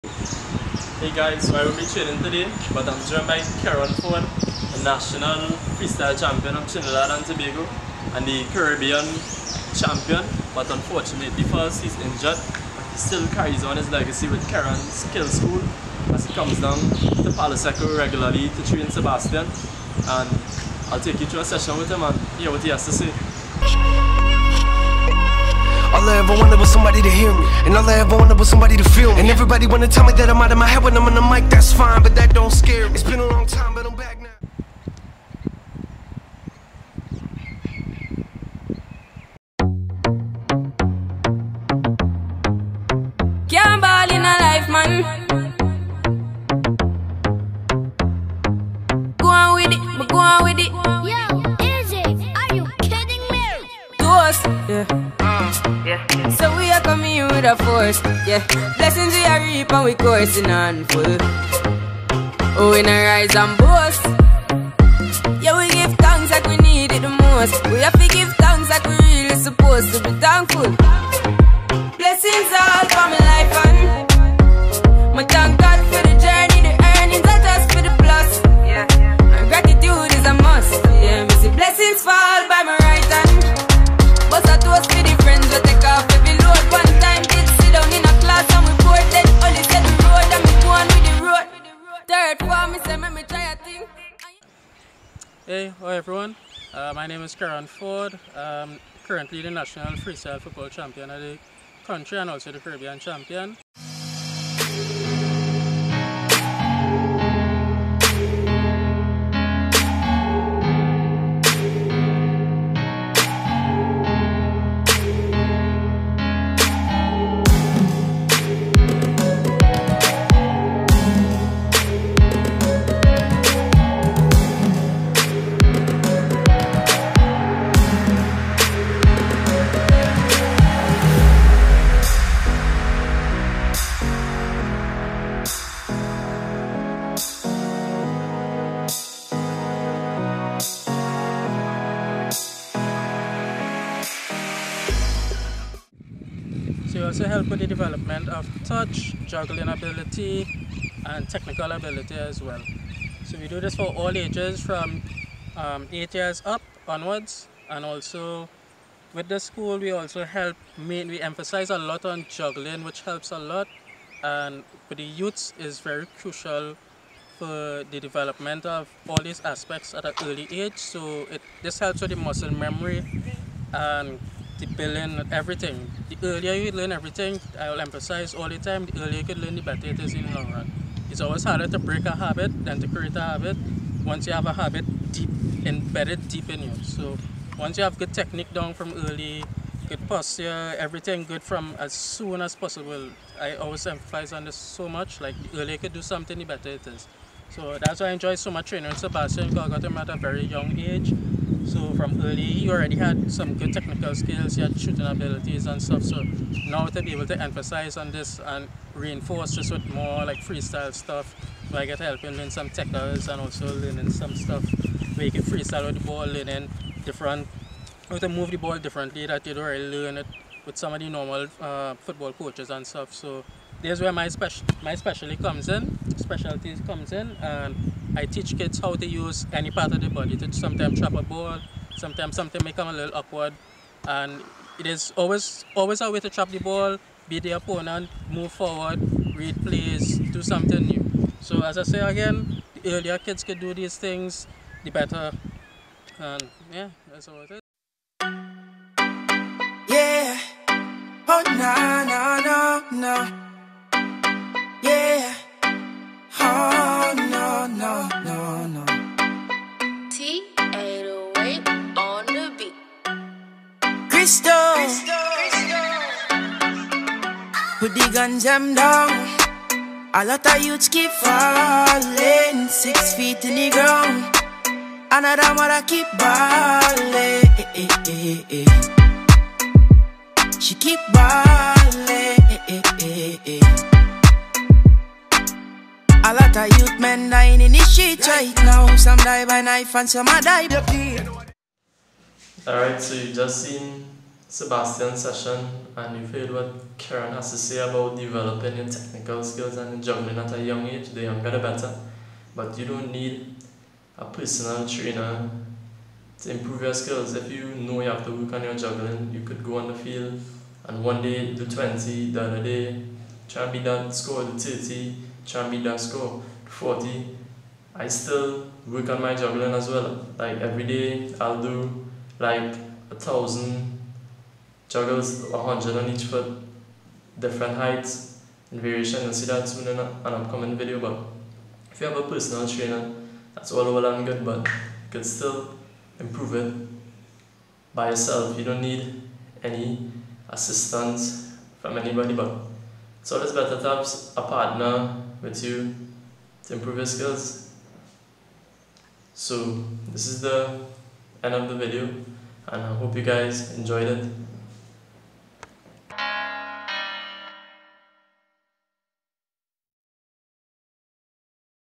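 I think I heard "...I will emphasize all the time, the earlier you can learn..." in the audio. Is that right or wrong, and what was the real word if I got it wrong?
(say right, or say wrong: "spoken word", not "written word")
right.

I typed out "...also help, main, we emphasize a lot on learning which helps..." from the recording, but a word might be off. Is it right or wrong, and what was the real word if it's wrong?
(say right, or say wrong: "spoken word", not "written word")
wrong: "juggling", not "learning".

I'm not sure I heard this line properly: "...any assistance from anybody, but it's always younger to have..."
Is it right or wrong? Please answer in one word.
wrong.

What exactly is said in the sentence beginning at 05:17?
I still work on my juggling as well.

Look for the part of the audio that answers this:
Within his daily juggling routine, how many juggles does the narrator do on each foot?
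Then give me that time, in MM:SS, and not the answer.
05:25.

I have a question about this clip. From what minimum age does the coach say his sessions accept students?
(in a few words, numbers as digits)
8 years.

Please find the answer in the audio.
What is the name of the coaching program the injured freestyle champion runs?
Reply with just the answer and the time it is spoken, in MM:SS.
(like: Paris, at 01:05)
Kerron's Skill School, at 00:14.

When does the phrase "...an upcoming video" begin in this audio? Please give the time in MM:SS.
05:29.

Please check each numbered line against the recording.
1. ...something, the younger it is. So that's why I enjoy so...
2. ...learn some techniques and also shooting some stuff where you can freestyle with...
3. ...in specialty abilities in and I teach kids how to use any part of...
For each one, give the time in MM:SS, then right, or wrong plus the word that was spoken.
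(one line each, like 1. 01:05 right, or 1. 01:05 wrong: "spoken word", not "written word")
1. 03:16 wrong: "better", not "younger"
2. 03:32 wrong: "learning", not "shooting"
3. 03:45 wrong: "comes", not "abilities".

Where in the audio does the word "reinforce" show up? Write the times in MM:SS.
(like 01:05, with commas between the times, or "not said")
03:28.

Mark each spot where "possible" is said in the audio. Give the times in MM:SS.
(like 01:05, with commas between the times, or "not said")
03:12.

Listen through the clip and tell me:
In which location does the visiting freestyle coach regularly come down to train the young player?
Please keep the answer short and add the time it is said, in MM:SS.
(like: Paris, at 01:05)
Palo Seco, at 00:17.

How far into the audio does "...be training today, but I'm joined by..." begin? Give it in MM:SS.
00:01.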